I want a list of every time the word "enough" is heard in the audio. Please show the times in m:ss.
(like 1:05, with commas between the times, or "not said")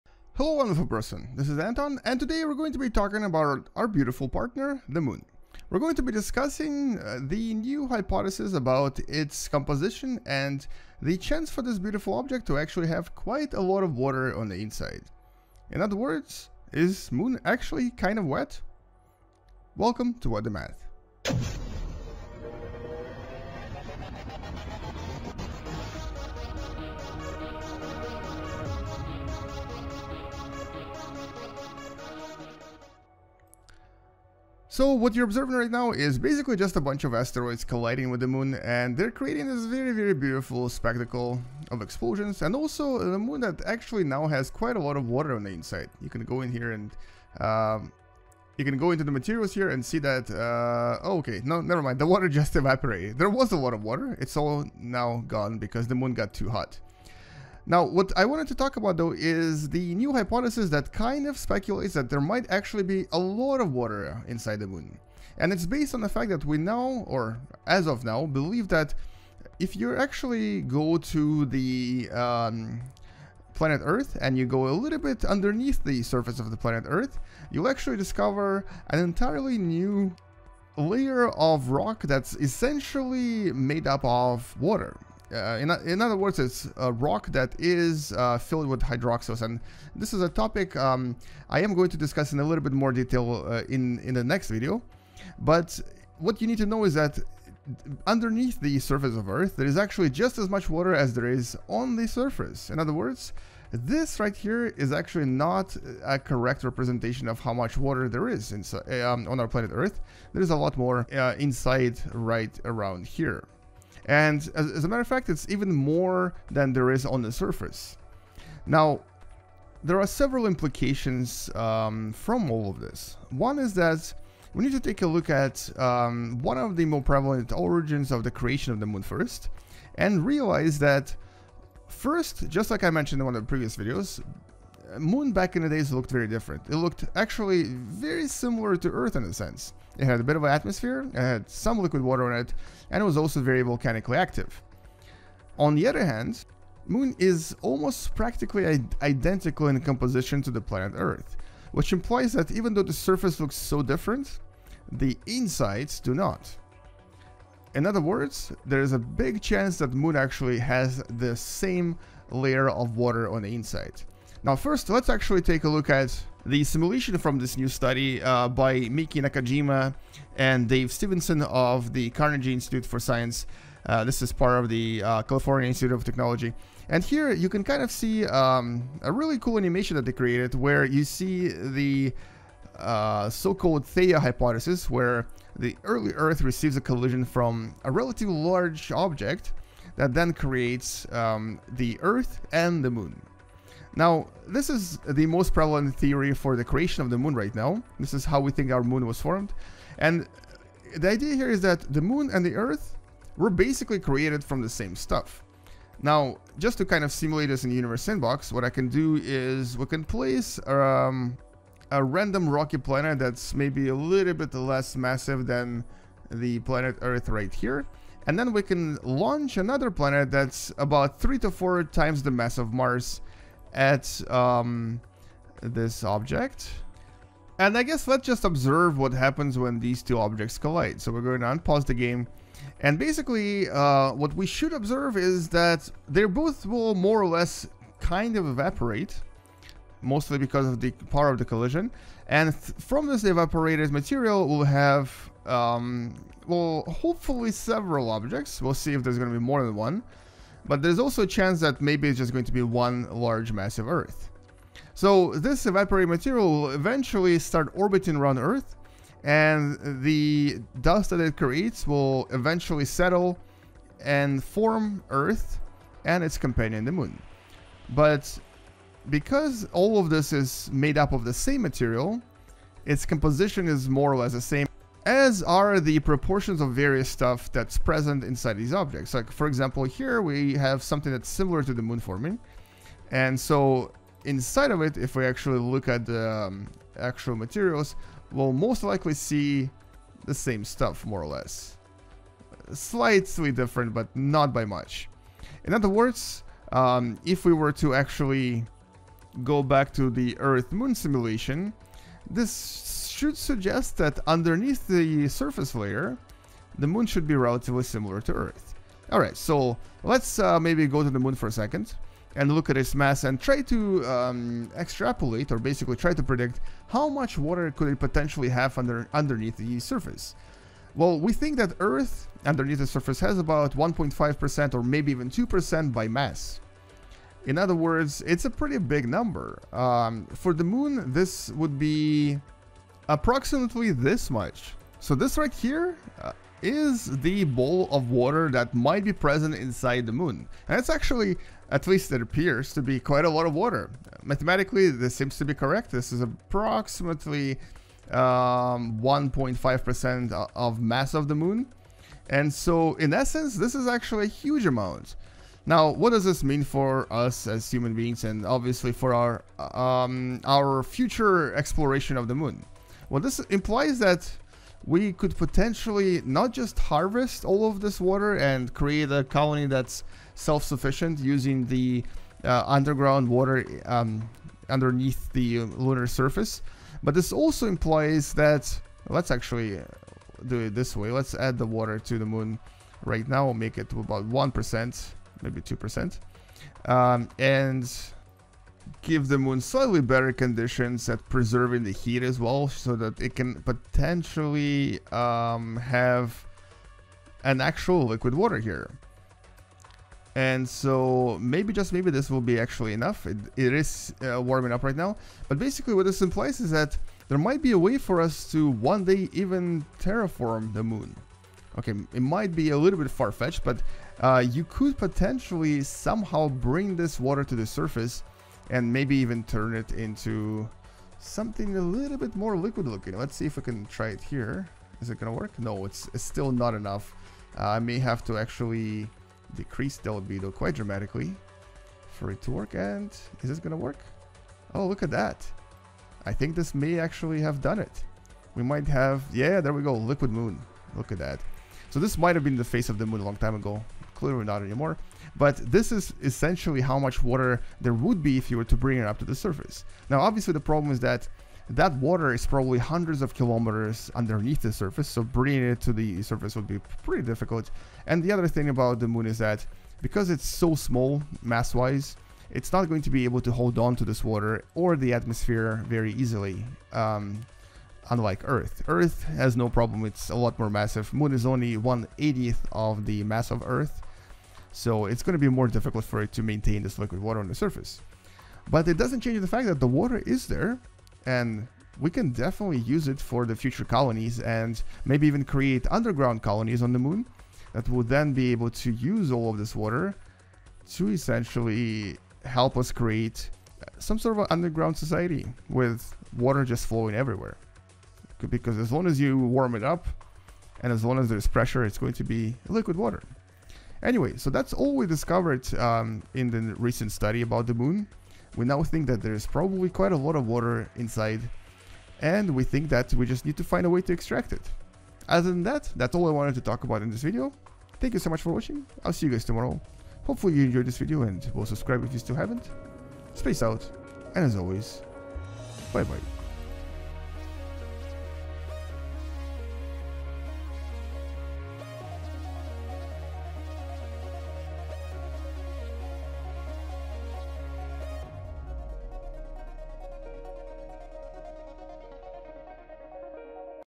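6:42, 7:06.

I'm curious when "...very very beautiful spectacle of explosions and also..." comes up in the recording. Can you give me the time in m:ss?
0:39.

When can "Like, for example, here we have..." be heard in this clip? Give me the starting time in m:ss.
4:39.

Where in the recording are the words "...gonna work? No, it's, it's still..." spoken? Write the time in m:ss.
7:05.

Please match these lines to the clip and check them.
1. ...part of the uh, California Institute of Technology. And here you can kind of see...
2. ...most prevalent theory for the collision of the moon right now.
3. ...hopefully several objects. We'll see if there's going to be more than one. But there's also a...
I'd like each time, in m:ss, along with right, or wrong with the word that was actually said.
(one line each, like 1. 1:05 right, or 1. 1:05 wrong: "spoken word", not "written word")
1. 2:54 right
2. 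3:15 wrong: "creation", not "collision"
3. 4:06 right.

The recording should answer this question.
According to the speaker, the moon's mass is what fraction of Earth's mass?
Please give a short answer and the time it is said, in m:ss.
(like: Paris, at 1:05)
1/80, at 7:51.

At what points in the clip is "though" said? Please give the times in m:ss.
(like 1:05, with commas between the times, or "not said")
0:58, 2:32.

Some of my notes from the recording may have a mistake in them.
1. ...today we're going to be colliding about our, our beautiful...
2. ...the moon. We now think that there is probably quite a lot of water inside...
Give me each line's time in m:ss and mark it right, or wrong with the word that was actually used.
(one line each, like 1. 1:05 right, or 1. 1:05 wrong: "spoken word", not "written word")
1. 0:02 wrong: "talking", not "colliding"
2. 8:27 right.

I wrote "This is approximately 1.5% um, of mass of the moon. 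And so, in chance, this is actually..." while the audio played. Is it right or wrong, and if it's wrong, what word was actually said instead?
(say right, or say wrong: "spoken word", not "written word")
wrong: "essence", not "chance".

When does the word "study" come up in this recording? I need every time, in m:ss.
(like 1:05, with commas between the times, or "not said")
2:47, 8:27.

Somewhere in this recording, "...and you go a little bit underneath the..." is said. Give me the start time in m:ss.
1:14.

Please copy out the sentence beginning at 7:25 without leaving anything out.
But this is essentially how much water there would be if you were to bring it up to the surface.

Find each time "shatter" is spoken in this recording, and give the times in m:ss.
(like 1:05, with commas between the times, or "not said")
not said.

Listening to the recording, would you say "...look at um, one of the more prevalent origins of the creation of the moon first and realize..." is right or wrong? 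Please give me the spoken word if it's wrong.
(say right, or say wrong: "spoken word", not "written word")
right.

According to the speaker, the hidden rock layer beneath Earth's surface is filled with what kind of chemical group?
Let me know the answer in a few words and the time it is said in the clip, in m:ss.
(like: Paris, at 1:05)
hydroxyls, at 1:28.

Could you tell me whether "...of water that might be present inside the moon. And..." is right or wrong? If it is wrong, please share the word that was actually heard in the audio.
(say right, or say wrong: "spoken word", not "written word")
right.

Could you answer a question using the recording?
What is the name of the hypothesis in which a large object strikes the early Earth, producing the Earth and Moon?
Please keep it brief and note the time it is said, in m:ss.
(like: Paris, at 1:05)
Theia hypothesis, at 3:03.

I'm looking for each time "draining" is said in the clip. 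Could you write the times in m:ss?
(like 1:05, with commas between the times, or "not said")
not said.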